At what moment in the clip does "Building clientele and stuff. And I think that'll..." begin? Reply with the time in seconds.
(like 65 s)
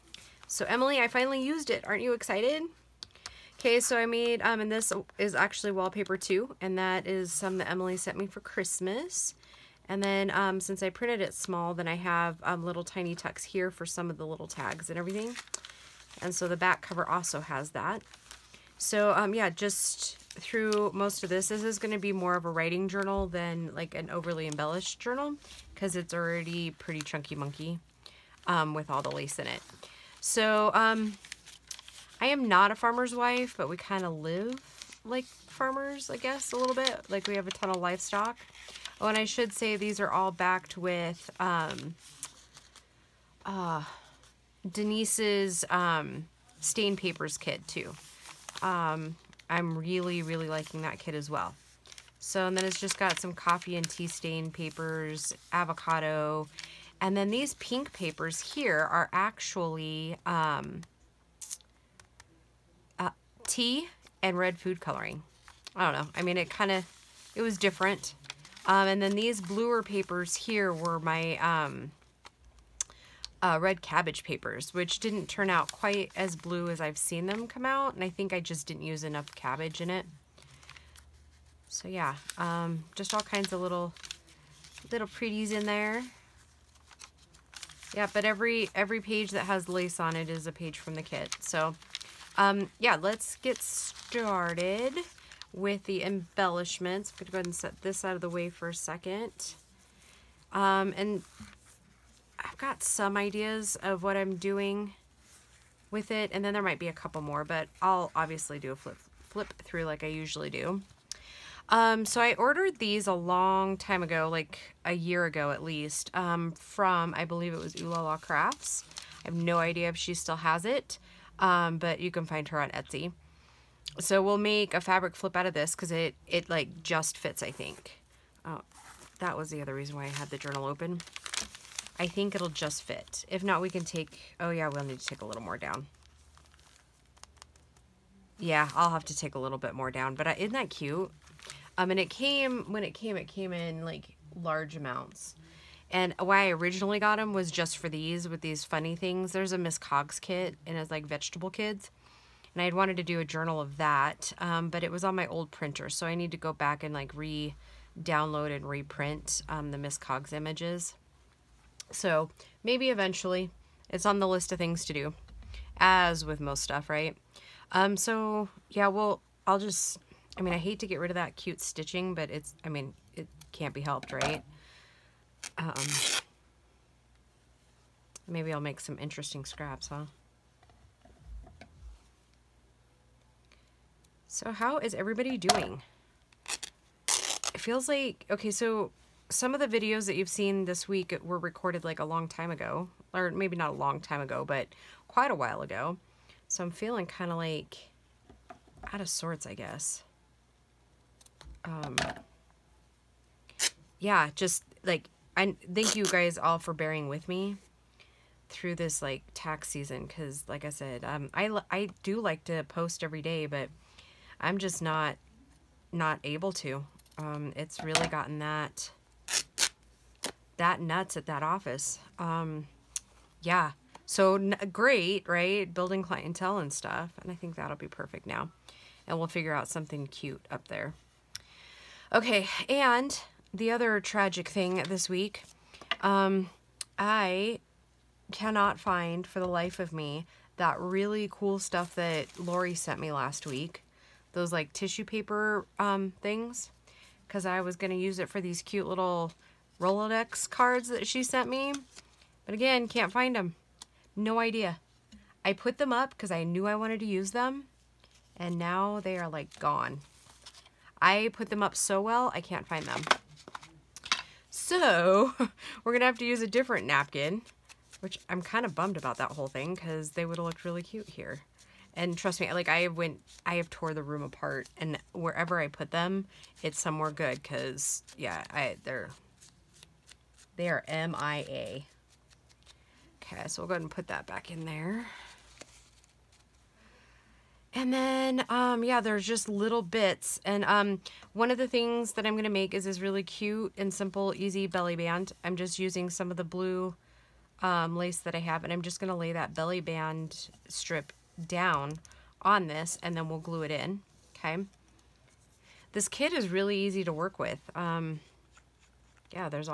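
225 s.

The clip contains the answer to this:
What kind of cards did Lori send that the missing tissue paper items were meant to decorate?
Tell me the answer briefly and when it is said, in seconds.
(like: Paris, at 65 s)
Rolodex cards, at 249 s.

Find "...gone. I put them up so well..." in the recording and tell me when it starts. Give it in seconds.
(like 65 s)
259 s.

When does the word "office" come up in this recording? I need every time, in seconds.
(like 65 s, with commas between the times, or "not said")
221 s.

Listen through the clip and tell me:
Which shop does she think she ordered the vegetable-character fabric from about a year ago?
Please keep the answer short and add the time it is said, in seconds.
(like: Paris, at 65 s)
Ooh La La Crafts, at 117 s.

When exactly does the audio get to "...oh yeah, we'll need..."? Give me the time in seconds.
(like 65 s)
134 s.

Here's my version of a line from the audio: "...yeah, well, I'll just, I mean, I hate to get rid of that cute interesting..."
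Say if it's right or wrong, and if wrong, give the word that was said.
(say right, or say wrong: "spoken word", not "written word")
wrong: "stitching", not "interesting".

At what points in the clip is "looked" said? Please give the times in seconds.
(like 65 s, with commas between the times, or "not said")
270 s.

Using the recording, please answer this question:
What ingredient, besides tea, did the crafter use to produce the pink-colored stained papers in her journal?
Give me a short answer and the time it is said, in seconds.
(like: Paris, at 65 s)
red food coloring, at 64 s.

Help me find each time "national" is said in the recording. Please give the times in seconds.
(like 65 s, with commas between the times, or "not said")
not said.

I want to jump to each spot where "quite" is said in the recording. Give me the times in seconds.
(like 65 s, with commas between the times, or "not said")
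75 s, 195 s.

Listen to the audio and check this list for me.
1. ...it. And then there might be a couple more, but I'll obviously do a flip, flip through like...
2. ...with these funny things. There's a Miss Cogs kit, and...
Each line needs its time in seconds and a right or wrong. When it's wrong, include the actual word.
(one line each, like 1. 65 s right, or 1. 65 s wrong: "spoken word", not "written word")
1. 106 s right
2. 148 s right.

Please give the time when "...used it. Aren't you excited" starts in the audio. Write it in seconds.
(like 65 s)
1 s.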